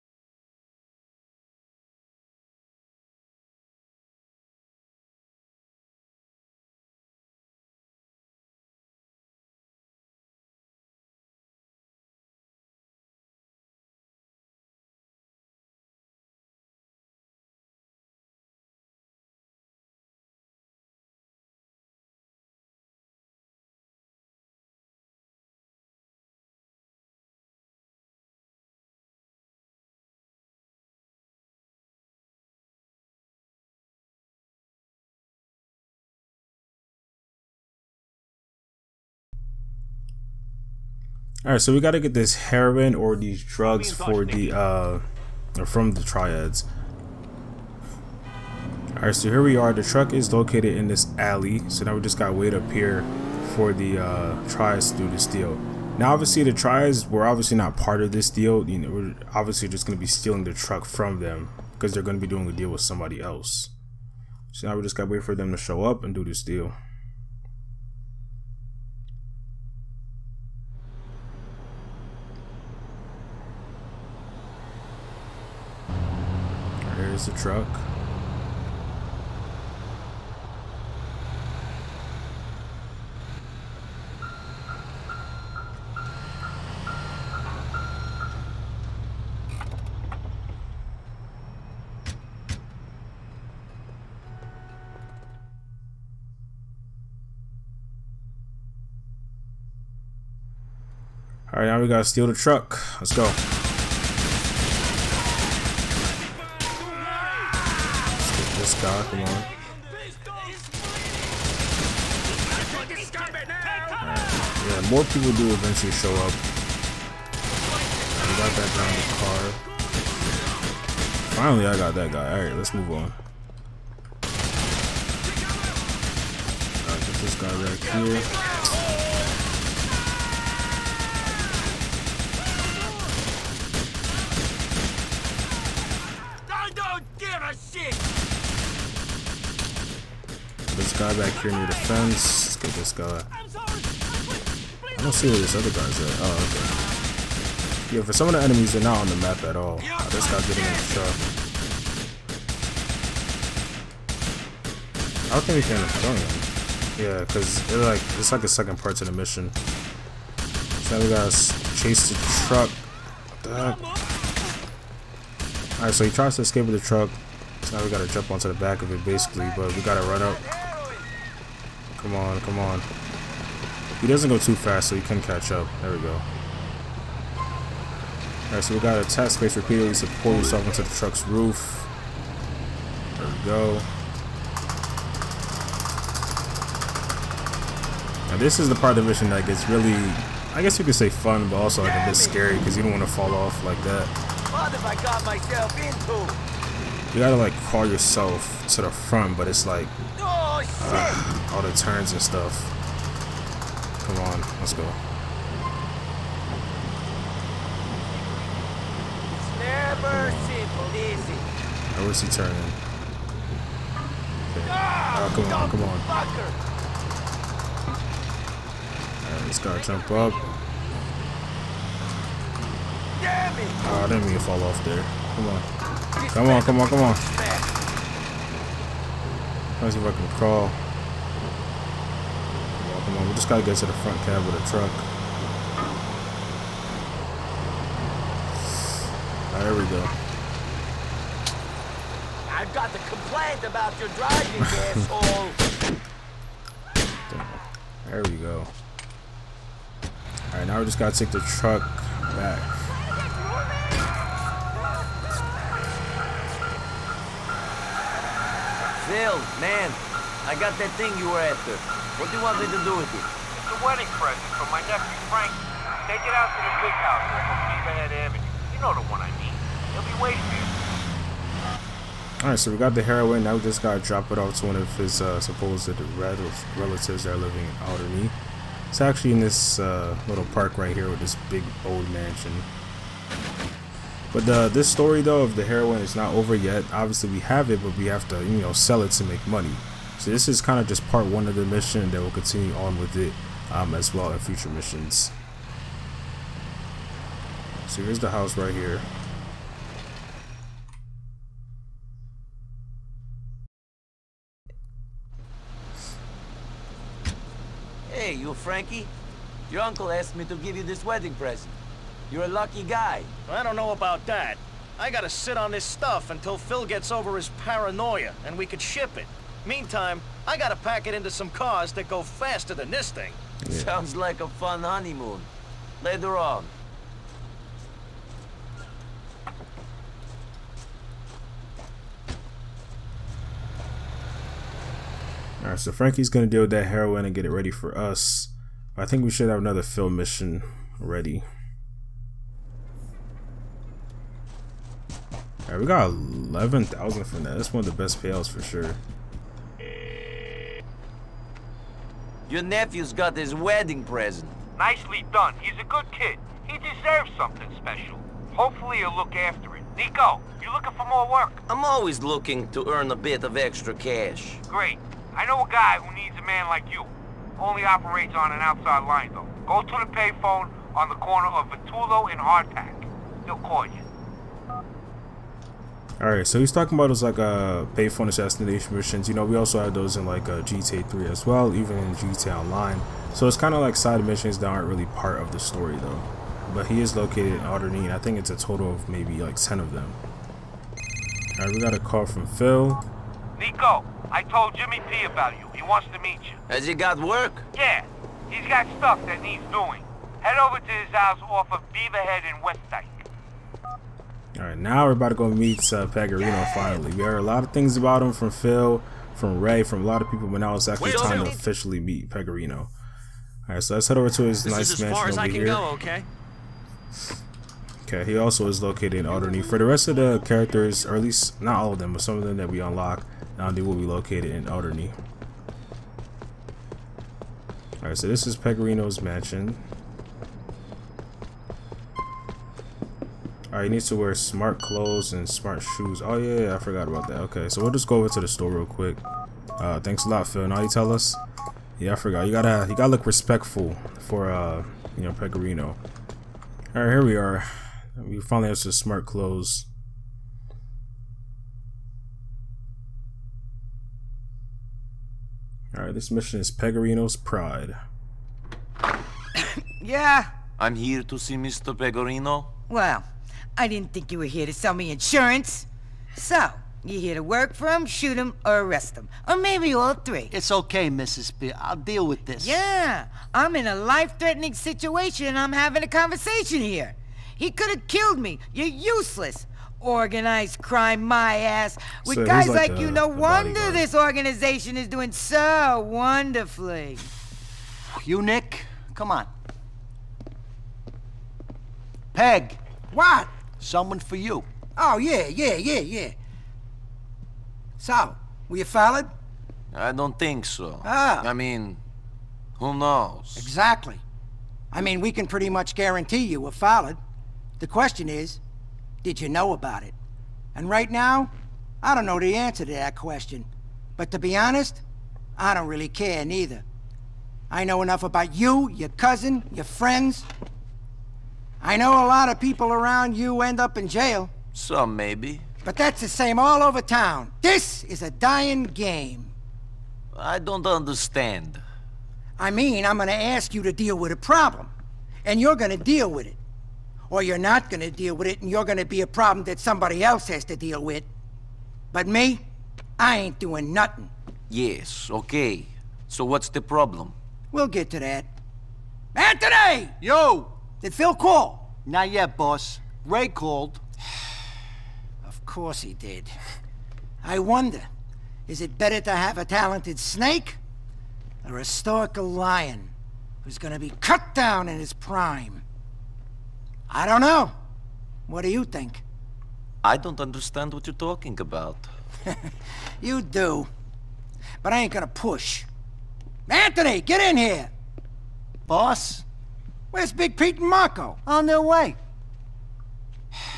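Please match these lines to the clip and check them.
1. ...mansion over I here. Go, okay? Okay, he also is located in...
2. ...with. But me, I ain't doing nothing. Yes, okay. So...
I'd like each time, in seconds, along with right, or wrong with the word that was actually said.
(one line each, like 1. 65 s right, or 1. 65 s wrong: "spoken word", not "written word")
1. 415 s right
2. 541 s right.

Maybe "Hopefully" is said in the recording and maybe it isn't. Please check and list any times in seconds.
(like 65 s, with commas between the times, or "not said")
358 s.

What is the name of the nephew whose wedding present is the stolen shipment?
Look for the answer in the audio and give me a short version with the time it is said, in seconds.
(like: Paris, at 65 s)
Frank, at 265 s.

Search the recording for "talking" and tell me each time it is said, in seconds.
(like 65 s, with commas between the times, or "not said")
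376 s, 571 s.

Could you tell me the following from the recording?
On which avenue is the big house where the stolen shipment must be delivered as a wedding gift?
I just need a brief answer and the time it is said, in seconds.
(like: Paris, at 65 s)
Beaverhead Avenue, at 267 s.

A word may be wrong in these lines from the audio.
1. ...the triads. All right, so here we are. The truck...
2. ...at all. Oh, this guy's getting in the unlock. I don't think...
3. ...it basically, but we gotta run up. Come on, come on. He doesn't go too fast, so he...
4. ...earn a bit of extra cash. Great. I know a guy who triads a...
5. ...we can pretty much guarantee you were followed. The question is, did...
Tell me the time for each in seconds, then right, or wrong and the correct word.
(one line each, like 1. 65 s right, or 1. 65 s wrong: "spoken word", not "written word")
1. 45 s right
2. 149 s wrong: "truck", not "unlock"
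3. 168 s right
4. 362 s wrong: "needs", not "triads"
5. 505 s right.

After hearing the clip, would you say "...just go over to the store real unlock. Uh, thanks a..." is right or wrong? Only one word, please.
wrong.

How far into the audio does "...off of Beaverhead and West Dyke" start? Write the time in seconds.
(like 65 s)
401 s.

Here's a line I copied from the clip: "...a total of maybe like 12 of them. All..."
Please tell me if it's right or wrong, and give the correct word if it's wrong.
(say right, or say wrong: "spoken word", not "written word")
wrong: "10", not "12".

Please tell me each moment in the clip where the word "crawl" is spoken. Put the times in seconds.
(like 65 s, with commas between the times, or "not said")
197 s, 230 s.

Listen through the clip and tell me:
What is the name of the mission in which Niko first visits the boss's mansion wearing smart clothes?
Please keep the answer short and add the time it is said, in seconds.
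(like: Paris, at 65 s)
Pegorino's Pride, at 456 s.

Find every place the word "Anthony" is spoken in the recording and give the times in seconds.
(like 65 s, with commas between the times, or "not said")
549 s, 576 s.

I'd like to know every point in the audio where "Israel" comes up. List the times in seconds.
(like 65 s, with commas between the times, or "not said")
not said.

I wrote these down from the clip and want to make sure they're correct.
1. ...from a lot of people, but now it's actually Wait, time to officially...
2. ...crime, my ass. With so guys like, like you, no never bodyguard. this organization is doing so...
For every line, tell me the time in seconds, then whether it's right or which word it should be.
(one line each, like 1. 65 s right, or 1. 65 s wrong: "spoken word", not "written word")
1. 409 s right
2. 480 s wrong: "wonder", not "never".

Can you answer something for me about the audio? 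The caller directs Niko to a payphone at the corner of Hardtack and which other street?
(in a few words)
Vitullo.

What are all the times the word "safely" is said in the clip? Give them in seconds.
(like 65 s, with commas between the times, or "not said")
not said.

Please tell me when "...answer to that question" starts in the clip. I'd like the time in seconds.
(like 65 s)
512 s.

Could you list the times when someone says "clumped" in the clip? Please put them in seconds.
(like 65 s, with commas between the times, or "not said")
not said.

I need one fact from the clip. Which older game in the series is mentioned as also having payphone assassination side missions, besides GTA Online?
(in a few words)
GTA 3.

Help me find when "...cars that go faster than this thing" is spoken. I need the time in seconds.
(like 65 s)
321 s.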